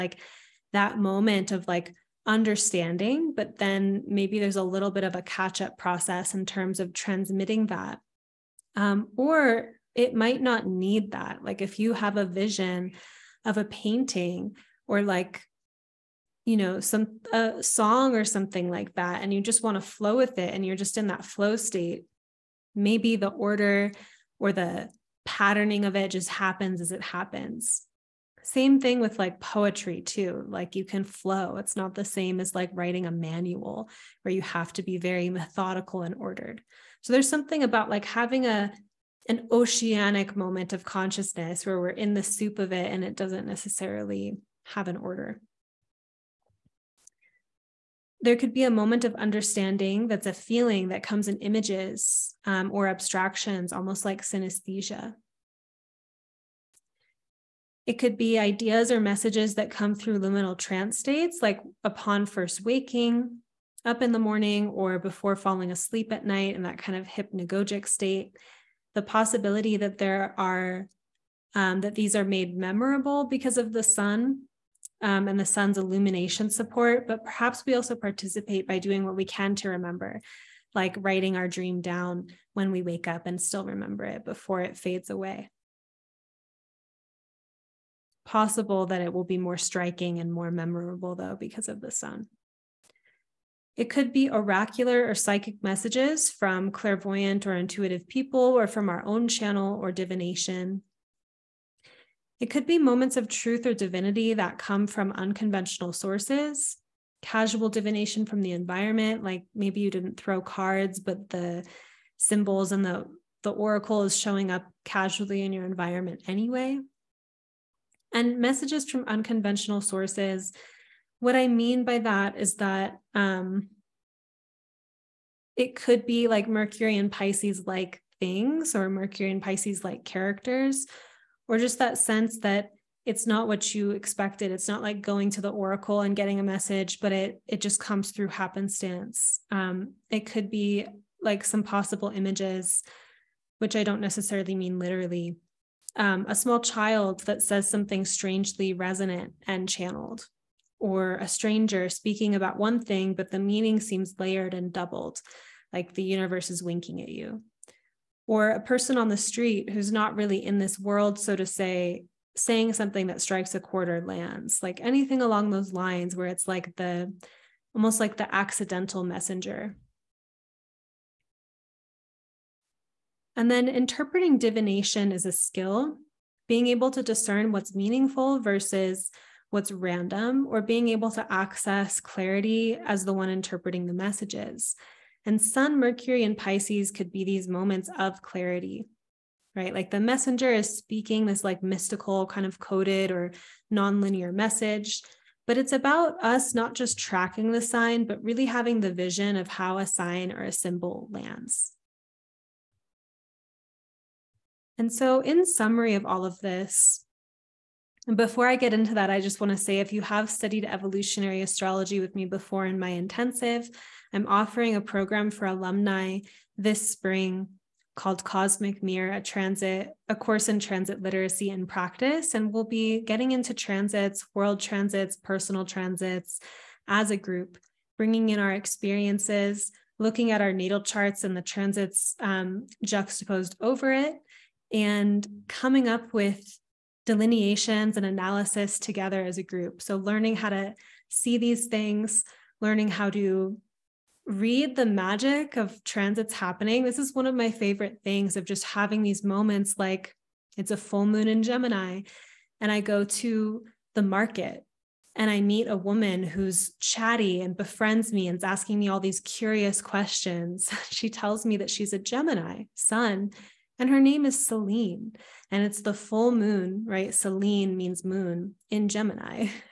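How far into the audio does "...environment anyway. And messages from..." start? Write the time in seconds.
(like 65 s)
115 s.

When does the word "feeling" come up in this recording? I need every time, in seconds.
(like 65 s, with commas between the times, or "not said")
50 s.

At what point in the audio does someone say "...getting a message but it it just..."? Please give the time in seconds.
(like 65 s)
136 s.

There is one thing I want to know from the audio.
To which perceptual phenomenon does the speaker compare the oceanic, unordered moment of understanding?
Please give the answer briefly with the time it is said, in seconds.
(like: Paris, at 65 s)
synesthesia, at 54 s.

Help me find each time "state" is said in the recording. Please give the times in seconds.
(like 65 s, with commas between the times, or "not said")
21 s, 60 s, 67 s.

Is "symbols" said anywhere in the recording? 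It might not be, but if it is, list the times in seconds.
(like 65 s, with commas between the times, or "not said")
112 s, 200 s.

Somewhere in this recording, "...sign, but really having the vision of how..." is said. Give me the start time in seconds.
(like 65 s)
197 s.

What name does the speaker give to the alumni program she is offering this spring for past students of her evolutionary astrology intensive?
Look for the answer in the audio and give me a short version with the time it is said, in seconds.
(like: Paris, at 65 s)
Cosmic Mirror, at 218 s.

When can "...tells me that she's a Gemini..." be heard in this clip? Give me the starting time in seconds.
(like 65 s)
261 s.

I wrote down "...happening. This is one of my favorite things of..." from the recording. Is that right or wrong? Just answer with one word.
right.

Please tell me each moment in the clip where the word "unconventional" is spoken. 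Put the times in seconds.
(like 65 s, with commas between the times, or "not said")
105 s, 119 s.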